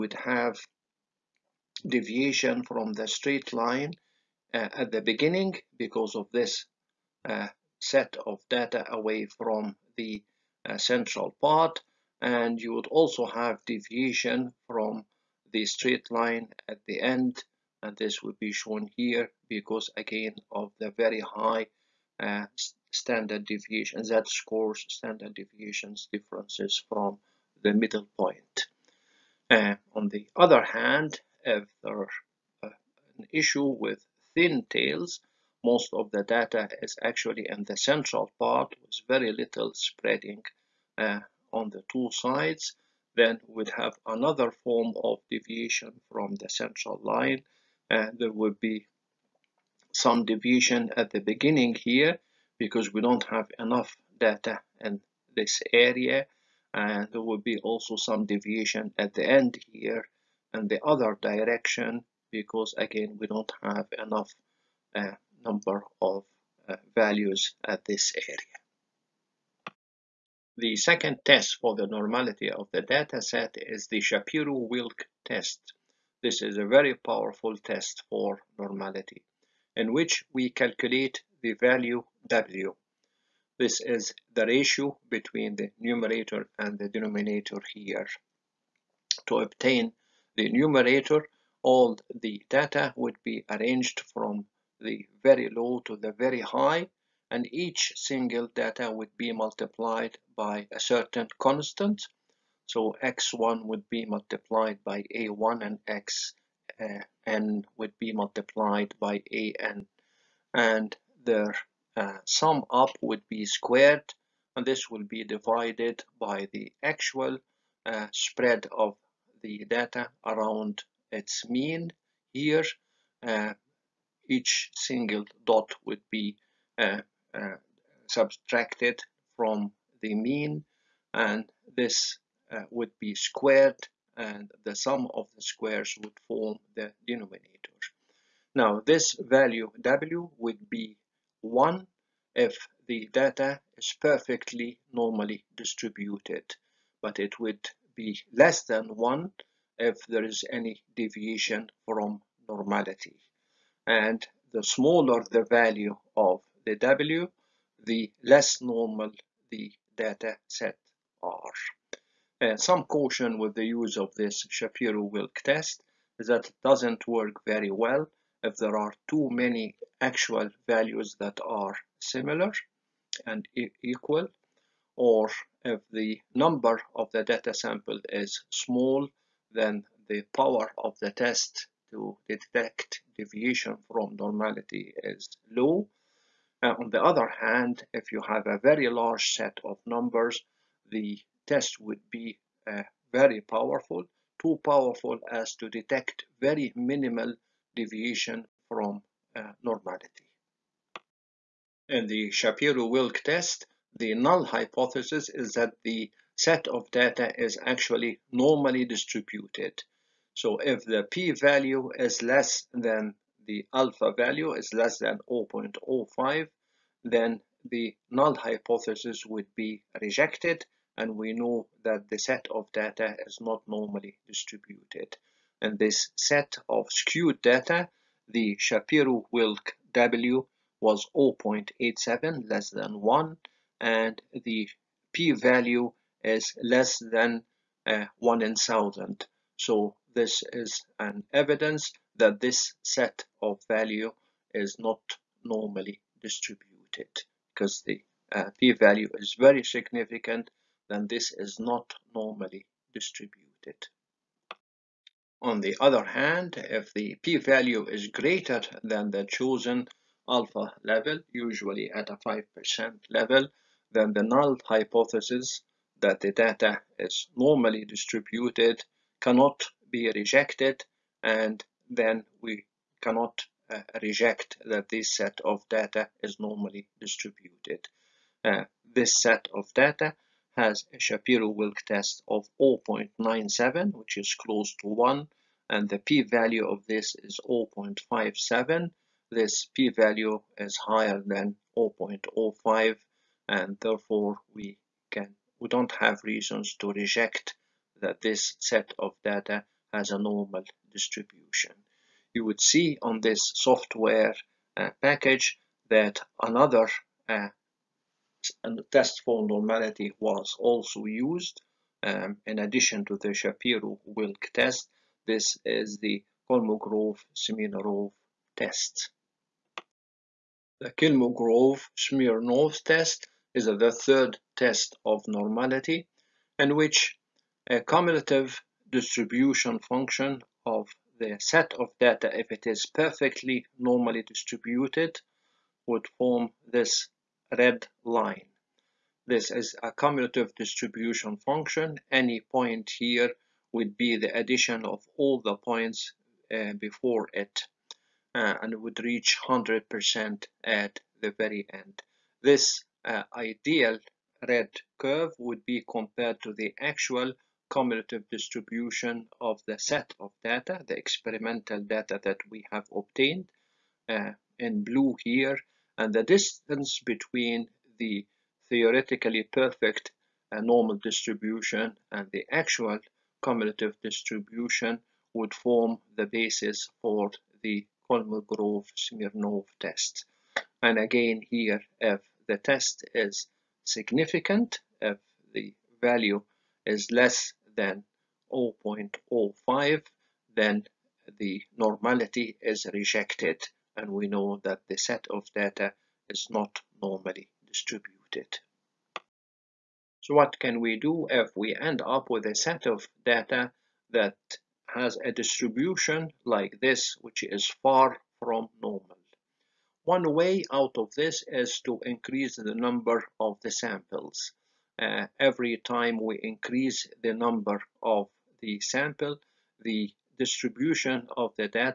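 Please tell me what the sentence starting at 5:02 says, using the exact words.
You would see on this software uh, package that another uh, test for normality was also used.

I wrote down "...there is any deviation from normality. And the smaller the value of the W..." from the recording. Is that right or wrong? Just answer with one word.
right.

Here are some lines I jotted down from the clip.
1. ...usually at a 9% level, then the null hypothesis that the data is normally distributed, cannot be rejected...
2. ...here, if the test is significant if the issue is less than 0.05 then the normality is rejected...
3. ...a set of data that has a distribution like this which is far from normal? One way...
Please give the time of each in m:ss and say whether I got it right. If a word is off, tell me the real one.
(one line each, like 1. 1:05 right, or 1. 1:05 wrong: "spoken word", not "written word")
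1. 4:21 wrong: "5", not "9"
2. 6:21 wrong: "value", not "issue"
3. 6:42 right.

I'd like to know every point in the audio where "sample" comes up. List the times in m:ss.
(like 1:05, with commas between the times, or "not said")
2:57, 6:53, 6:58.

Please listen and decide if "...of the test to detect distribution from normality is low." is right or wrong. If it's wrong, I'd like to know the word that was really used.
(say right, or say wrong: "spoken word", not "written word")
wrong: "deviation", not "distribution".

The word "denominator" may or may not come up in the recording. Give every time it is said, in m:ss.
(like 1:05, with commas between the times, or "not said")
1:26, 2:17.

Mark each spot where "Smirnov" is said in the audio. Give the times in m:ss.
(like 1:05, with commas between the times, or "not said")
5:16, 5:20, 6:18.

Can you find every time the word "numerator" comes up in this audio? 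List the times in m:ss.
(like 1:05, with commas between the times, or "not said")
1:25, 1:30.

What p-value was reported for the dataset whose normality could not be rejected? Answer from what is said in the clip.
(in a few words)
0.57.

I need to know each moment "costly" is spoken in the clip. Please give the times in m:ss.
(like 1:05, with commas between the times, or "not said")
not said.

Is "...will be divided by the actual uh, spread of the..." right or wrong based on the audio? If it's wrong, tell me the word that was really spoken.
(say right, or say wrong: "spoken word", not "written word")
right.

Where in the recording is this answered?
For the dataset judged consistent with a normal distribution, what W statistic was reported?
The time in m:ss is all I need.
4:42.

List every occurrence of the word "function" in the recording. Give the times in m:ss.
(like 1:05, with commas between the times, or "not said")
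5:29, 5:41.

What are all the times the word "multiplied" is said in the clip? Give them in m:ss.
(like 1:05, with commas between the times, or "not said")
1:39, 1:44, 1:48.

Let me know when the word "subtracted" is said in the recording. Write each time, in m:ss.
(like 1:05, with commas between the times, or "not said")
2:08.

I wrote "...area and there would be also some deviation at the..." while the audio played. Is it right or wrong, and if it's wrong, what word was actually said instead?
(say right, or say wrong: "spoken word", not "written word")
right.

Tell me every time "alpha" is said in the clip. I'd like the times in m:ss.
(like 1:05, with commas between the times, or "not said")
3:33, 4:20.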